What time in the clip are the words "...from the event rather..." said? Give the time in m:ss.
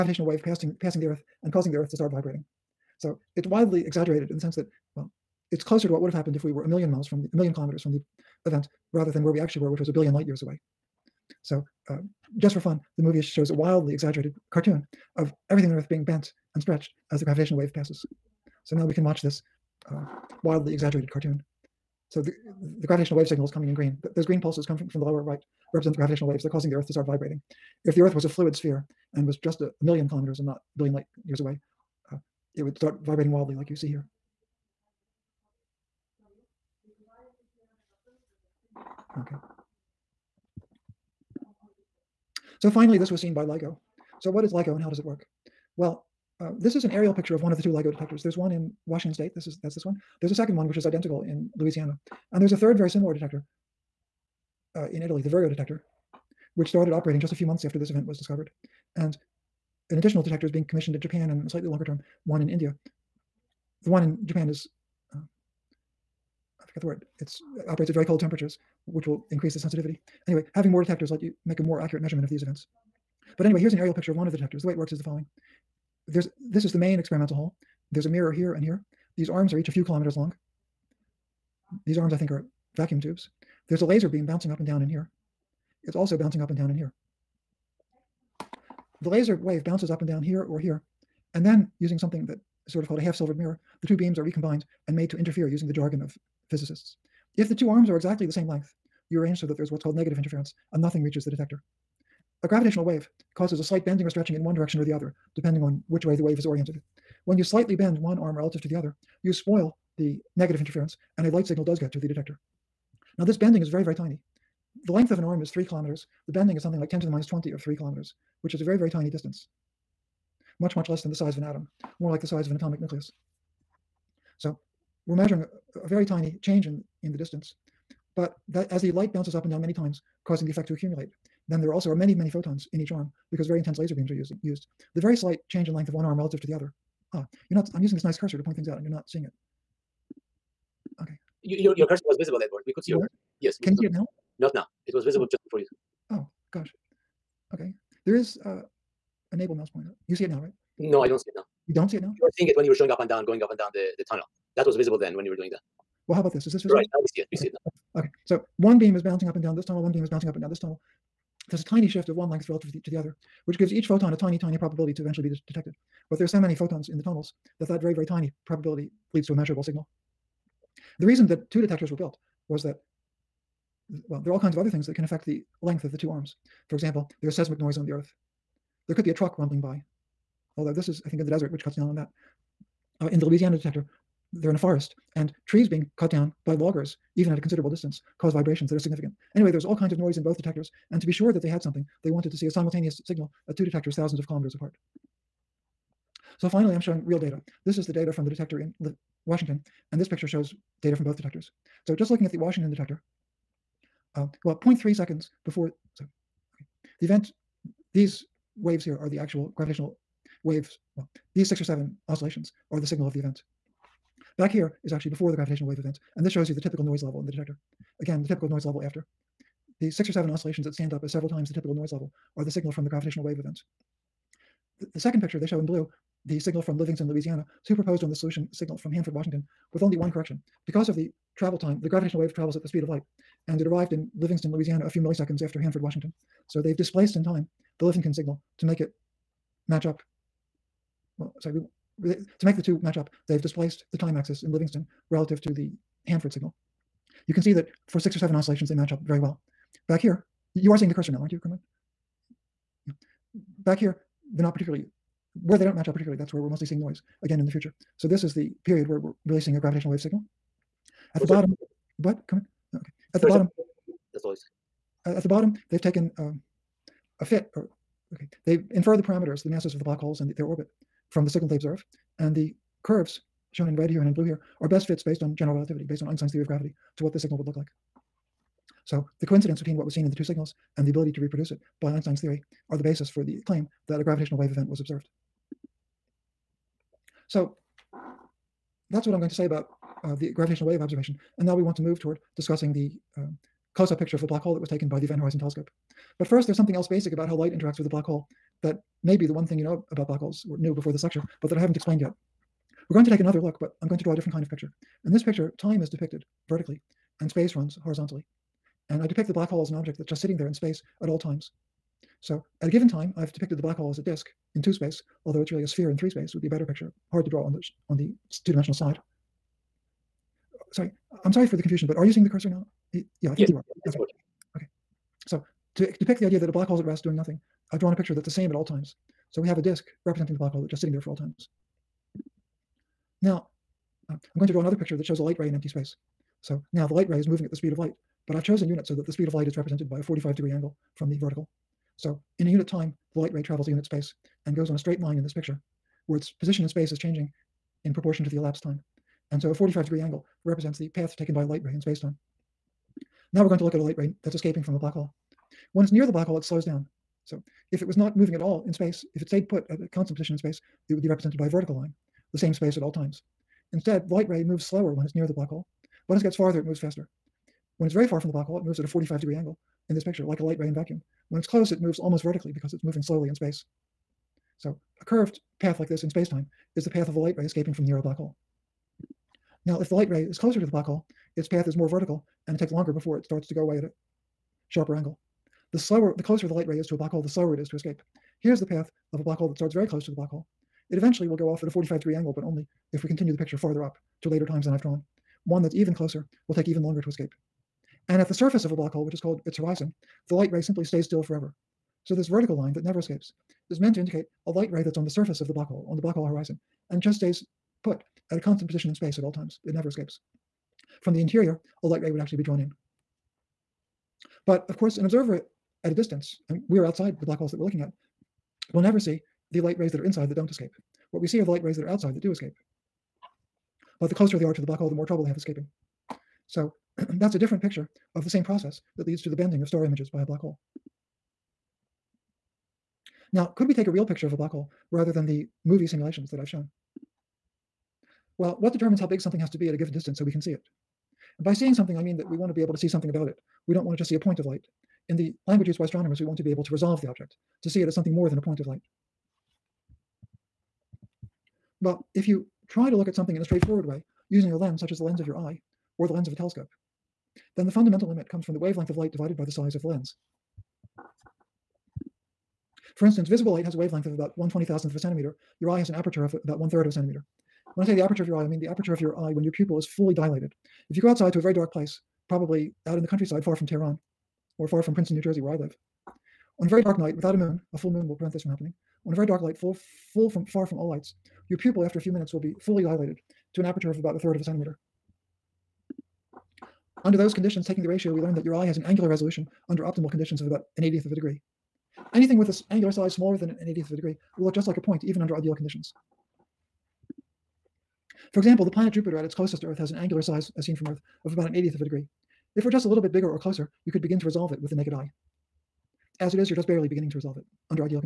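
0:07.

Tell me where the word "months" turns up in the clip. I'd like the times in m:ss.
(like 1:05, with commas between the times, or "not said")
0:57.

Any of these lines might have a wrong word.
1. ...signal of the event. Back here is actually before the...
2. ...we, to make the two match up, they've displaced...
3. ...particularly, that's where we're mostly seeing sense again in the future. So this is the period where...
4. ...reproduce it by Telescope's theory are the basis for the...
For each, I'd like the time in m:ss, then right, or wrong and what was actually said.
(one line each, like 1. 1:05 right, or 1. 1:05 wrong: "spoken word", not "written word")
1. 3:32 right
2. 4:01 right
3. 4:15 wrong: "noise", not "sense"
4. 4:41 wrong: "Einstein", not "Telescope".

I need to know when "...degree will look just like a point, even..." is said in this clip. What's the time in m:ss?
8:13.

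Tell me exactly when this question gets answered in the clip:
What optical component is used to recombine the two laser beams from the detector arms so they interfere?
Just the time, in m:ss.
1:33.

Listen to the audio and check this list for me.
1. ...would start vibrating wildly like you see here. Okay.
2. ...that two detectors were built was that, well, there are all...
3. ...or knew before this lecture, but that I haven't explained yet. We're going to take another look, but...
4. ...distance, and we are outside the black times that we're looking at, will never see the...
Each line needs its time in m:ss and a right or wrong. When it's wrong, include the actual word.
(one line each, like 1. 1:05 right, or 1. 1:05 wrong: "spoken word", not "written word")
1. 0:32 right
2. 2:51 right
3. 5:00 right
4. 6:55 wrong: "holes", not "times".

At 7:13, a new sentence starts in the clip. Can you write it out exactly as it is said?
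Now, could we take a real picture of a black hole rather than the movie simulations that I've shown?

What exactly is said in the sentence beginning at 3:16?
So finally, I'm showing real data.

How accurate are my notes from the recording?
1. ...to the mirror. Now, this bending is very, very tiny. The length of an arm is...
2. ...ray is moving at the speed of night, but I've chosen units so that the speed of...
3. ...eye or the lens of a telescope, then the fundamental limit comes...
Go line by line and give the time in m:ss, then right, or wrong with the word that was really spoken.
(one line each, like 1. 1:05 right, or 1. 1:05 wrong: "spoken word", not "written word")
1. 1:51 wrong: "detector", not "mirror"
2. 5:37 wrong: "light", not "night"
3. 7:35 right.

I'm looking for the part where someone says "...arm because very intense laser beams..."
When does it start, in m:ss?
2:12.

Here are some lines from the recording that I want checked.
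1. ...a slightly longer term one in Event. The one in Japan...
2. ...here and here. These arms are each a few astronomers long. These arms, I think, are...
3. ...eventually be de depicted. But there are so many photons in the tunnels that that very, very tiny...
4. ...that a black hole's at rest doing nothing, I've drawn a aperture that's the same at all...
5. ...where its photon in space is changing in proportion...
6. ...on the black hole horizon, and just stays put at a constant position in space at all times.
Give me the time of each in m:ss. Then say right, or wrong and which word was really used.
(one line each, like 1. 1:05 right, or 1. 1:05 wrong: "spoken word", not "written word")
1. 1:01 wrong: "India", not "Event"
2. 1:18 wrong: "kilometers", not "astronomers"
3. 2:45 wrong: "detected", not "depicted"
4. 5:26 wrong: "picture", not "aperture"
5. 5:46 wrong: "position", not "photon"
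6. 6:45 right.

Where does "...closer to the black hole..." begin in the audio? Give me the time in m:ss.
6:20.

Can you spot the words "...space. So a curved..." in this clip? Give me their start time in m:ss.
6:13.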